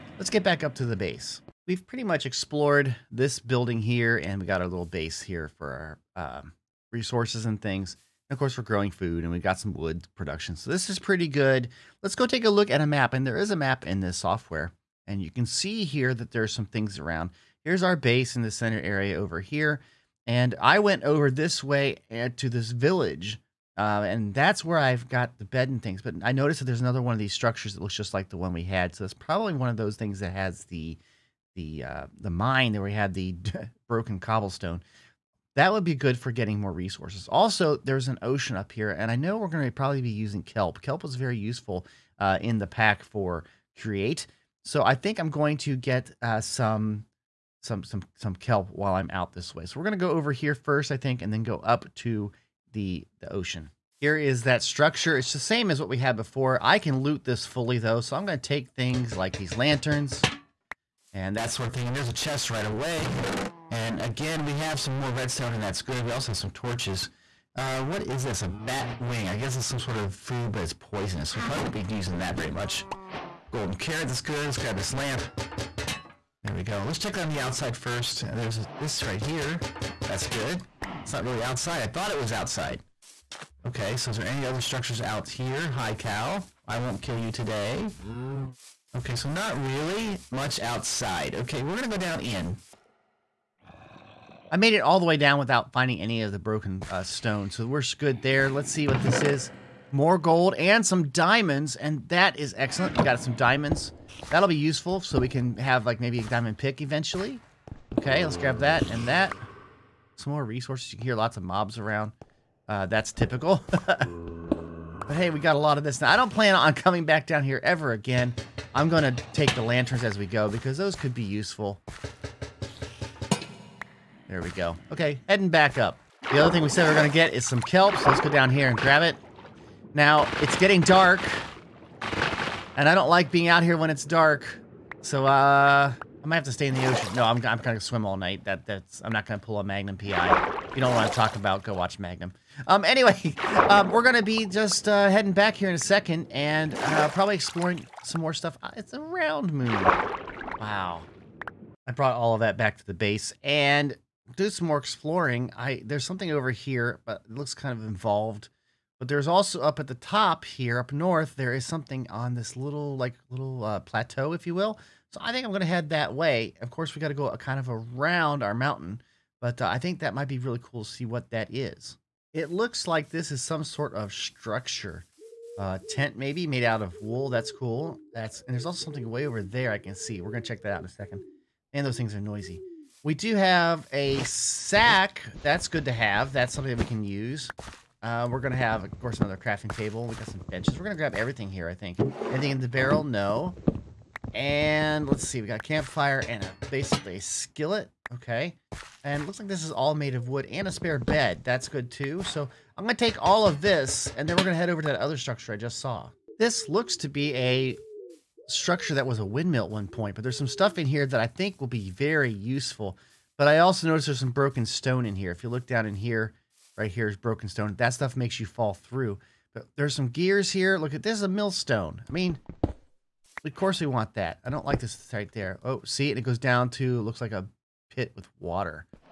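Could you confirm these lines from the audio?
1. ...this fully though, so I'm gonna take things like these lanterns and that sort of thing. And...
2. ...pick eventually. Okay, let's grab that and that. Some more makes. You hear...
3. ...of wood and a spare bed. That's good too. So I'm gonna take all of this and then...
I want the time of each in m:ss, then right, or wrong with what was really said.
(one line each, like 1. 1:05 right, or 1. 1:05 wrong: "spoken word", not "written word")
1. 0:57 right
2. 1:46 wrong: "resources", not "makes"
3. 3:20 right.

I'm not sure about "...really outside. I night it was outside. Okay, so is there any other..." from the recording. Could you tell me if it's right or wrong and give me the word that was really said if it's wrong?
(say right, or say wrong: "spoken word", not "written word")
wrong: "thought", not "night".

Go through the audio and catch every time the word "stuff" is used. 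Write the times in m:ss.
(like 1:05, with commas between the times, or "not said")
2:28, 3:30, 3:37.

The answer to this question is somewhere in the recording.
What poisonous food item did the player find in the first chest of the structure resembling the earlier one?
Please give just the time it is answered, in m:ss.
1:08.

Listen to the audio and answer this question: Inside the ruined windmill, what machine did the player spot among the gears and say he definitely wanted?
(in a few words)
Millstone.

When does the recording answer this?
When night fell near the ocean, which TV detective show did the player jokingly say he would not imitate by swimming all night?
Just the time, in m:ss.
2:19.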